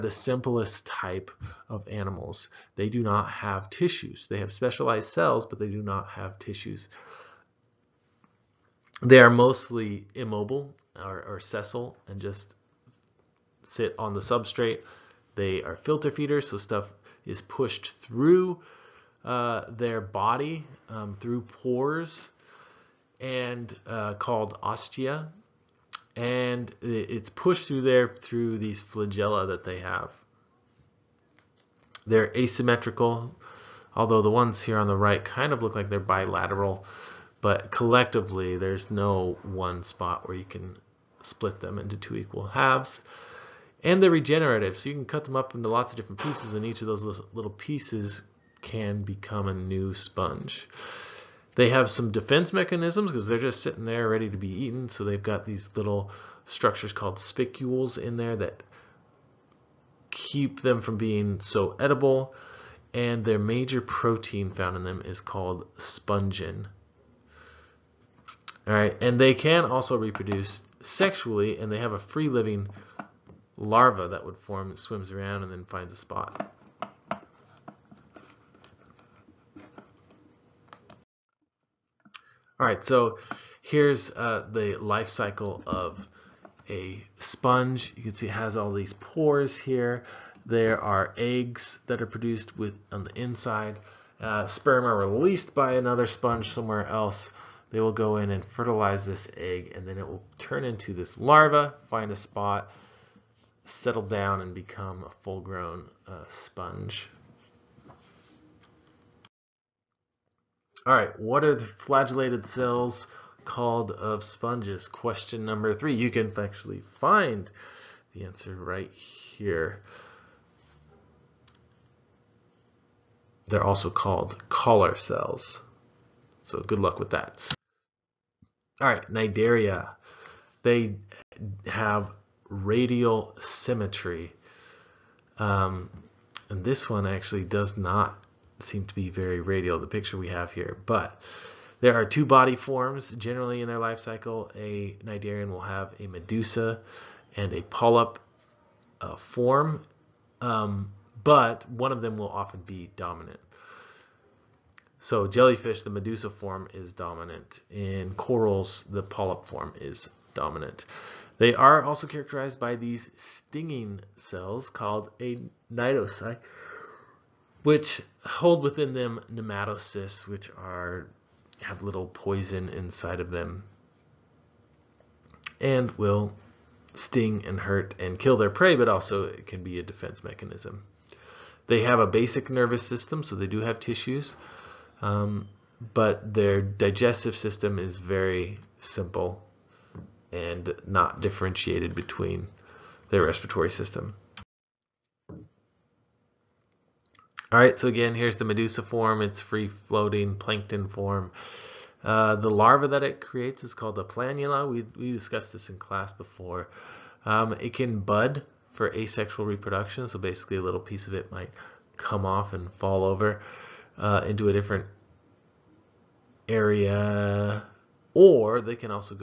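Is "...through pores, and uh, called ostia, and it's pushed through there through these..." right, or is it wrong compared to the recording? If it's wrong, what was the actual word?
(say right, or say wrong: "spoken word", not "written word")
right.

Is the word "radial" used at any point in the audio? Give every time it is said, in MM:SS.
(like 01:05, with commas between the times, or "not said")
02:12, 02:19.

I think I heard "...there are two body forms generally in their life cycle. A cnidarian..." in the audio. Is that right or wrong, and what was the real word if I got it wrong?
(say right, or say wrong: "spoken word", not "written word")
right.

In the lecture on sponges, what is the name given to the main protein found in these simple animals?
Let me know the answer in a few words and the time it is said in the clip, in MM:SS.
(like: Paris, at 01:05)
spongin, at 01:05.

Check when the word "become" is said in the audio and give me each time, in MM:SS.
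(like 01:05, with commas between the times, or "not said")
00:49, 01:44.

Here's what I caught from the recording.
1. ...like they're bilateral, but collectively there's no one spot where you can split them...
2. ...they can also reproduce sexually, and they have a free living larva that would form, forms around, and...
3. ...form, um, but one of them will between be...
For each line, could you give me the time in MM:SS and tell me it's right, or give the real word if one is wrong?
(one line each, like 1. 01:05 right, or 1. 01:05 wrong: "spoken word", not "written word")
1. 00:35 right
2. 01:09 wrong: "swims", not "forms"
3. 02:29 wrong: "often", not "between".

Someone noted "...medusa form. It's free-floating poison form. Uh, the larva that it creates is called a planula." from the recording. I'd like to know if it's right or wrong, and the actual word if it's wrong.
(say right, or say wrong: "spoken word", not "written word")
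wrong: "plankton", not "poison".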